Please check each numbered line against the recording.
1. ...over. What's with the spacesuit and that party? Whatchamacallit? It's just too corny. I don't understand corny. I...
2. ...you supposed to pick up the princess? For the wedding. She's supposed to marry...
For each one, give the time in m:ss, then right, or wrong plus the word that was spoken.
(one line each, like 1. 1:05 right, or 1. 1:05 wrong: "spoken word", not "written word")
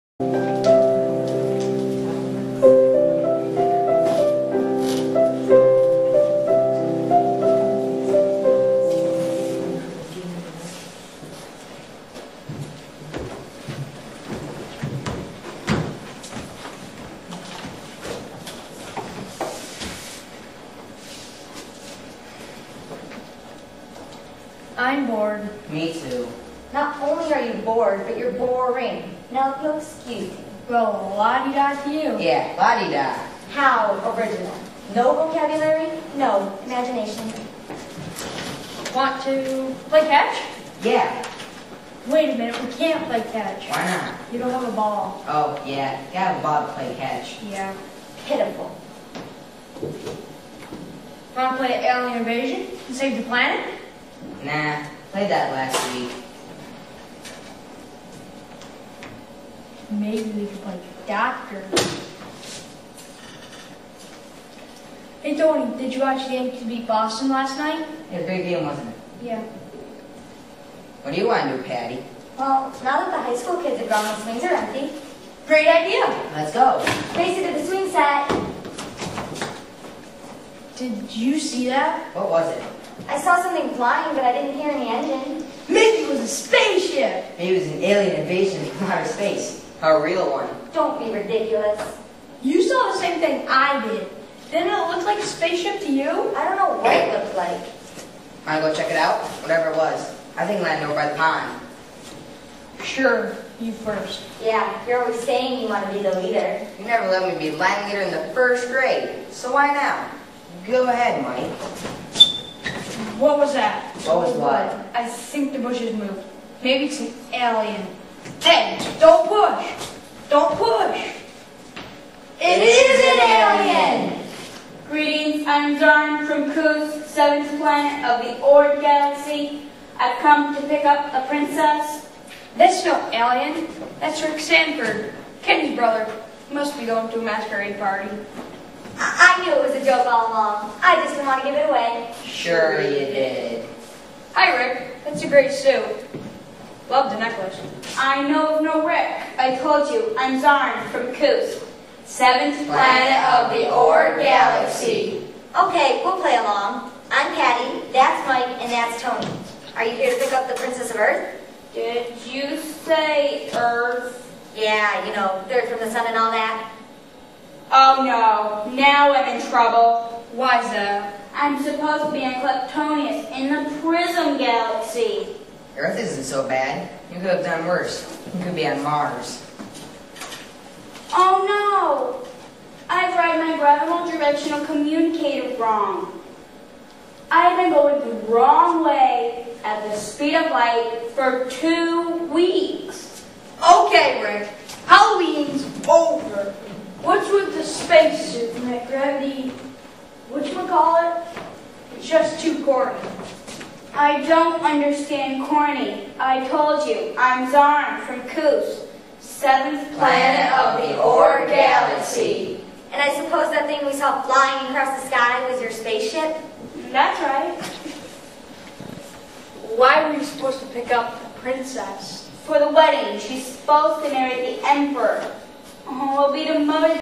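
1. 3:15 wrong: "gravity", not "party"
2. 3:40 right.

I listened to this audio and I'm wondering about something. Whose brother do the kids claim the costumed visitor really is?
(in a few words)
Kenny.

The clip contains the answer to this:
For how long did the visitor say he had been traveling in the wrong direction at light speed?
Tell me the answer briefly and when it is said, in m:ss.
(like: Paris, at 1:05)
2 weeks, at 3:11.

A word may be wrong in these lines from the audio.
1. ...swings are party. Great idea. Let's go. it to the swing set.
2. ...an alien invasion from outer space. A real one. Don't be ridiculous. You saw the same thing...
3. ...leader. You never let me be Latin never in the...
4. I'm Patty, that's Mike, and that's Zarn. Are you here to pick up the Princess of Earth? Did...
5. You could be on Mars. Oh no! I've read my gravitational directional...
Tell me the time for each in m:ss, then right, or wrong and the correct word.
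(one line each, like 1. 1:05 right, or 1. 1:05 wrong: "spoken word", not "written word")
1. 1:14 wrong: "empty", not "party"
2. 1:27 right
3. 1:46 wrong: "leader", not "never"
4. 2:37 wrong: "Tony", not "Zarn"
5. 2:58 right.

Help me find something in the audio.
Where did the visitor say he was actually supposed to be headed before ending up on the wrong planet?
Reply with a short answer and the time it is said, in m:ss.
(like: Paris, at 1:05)
Kleptonius, at 2:52.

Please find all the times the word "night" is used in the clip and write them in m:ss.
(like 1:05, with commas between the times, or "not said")
1:07.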